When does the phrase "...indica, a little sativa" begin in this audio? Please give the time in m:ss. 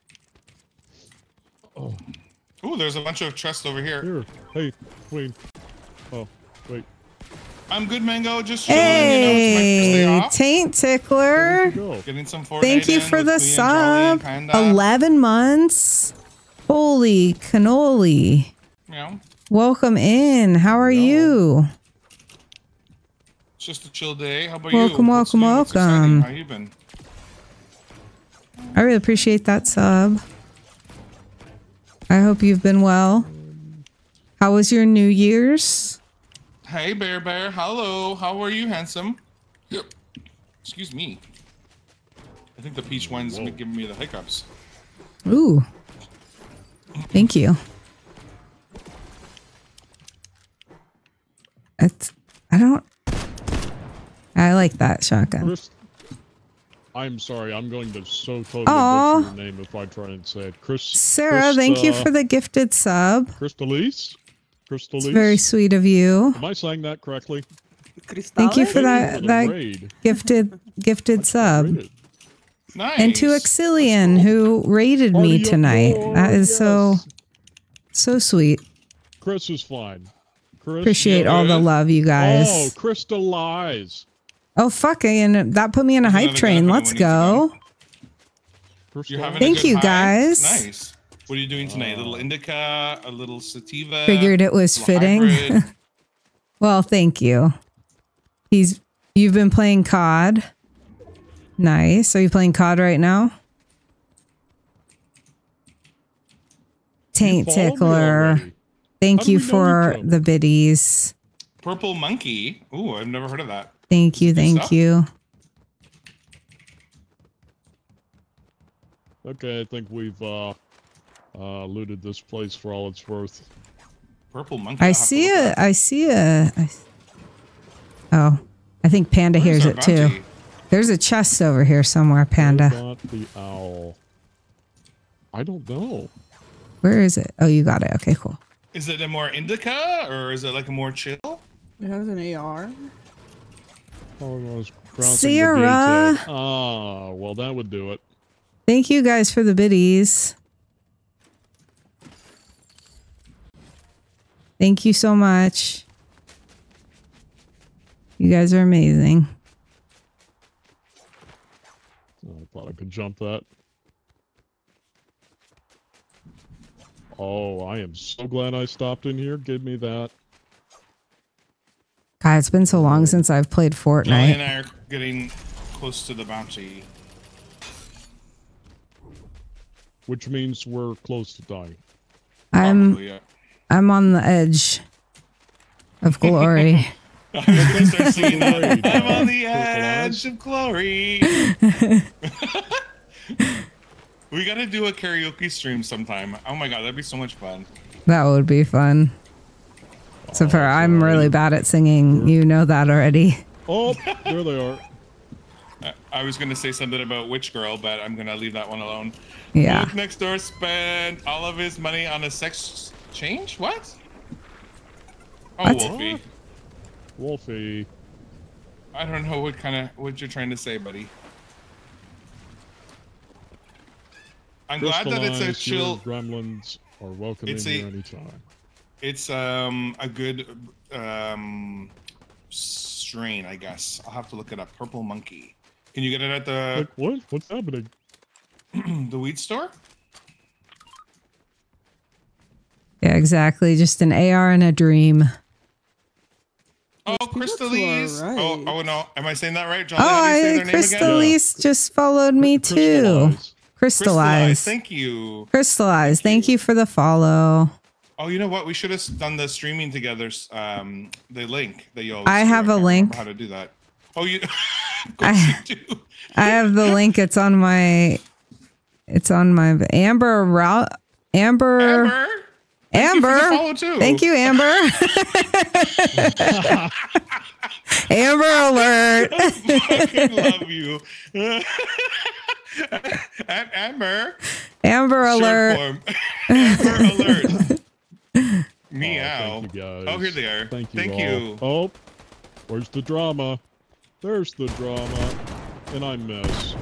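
1:32.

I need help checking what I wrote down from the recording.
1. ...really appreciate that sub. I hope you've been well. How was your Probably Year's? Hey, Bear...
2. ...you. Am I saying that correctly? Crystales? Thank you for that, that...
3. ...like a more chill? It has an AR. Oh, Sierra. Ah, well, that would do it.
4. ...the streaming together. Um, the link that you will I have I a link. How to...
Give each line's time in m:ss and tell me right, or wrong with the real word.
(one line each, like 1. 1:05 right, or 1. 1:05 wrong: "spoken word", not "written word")
1. 0:28 wrong: "New", not "Probably"
2. 1:05 right
3. 2:20 right
4. 4:19 right.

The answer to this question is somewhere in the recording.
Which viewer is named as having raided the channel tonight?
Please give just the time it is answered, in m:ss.
1:13.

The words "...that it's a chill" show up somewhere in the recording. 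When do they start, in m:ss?
3:45.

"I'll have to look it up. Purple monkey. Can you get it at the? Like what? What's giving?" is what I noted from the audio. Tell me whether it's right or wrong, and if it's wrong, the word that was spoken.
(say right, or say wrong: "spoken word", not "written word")
wrong: "happening", not "giving".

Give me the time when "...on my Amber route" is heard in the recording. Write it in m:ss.
4:29.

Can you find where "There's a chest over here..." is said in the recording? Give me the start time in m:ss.
2:10.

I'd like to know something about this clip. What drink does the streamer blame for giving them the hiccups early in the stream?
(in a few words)
peach wine.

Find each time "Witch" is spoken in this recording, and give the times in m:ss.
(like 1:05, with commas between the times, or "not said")
3:27.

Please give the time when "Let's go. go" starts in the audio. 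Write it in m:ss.
1:26.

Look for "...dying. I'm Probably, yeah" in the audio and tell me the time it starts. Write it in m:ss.
3:01.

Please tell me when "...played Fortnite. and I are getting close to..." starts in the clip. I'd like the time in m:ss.
2:53.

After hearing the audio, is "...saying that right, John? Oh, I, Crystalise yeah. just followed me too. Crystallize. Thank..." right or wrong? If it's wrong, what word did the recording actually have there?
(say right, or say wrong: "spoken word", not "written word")
right.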